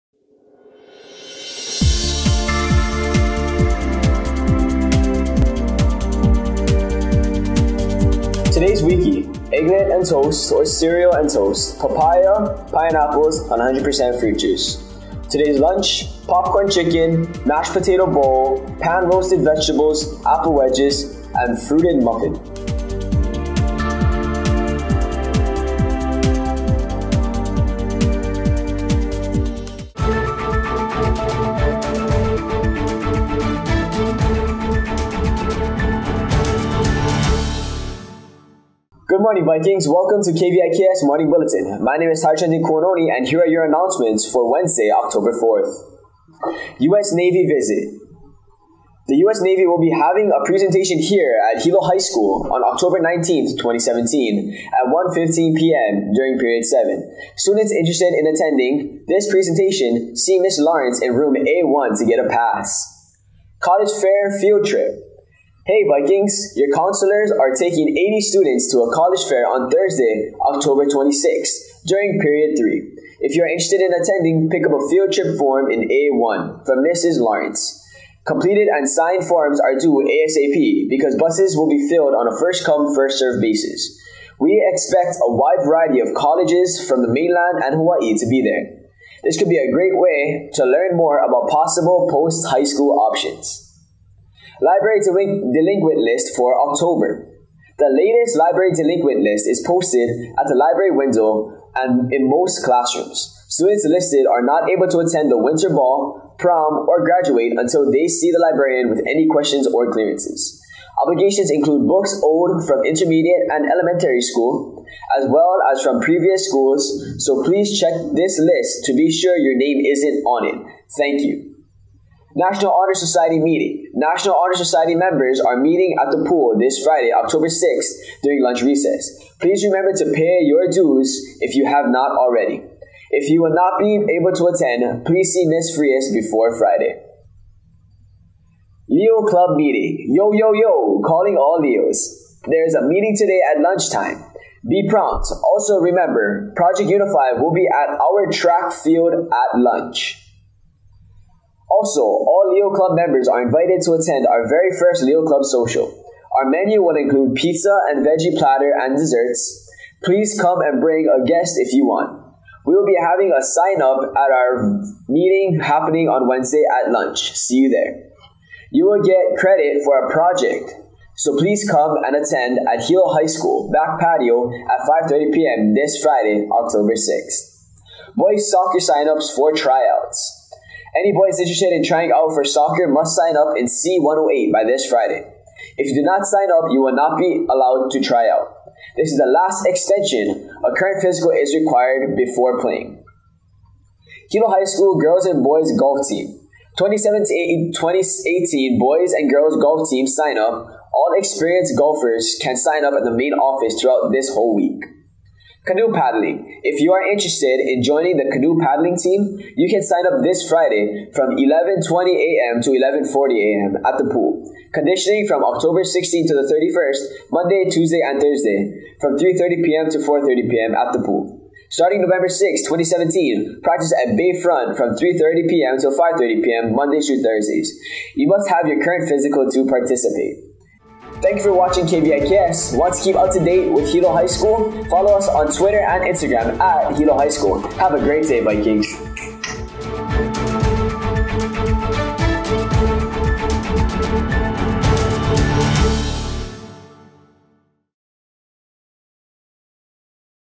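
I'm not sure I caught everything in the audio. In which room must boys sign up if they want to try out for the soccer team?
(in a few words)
C108.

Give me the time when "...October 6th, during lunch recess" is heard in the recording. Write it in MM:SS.
02:07.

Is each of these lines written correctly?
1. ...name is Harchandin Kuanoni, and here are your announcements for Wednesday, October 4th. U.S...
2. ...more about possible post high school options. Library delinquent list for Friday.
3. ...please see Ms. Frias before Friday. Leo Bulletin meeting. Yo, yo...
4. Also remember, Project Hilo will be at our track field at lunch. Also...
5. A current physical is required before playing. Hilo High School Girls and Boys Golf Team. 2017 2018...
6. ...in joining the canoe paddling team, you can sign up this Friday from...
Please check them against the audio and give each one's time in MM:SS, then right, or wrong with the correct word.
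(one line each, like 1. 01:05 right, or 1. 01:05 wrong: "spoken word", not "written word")
1. 00:42 right
2. 01:30 wrong: "October", not "Friday"
3. 02:15 wrong: "Club", not "Bulletin"
4. 02:25 wrong: "Unify", not "Hilo"
5. 03:10 right
6. 03:27 right.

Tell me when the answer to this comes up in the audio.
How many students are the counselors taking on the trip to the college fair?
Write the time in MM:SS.
01:07.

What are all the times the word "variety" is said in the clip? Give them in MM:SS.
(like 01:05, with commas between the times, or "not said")
01:25.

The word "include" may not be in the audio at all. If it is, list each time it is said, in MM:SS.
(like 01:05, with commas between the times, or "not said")
01:51, 02:36.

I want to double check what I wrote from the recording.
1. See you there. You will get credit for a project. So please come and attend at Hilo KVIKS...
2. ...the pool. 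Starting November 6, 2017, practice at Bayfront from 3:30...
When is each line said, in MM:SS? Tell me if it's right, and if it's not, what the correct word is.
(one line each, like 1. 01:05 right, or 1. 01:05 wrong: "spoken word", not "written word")
1. 02:47 wrong: "High", not "KVIKS"
2. 03:40 right.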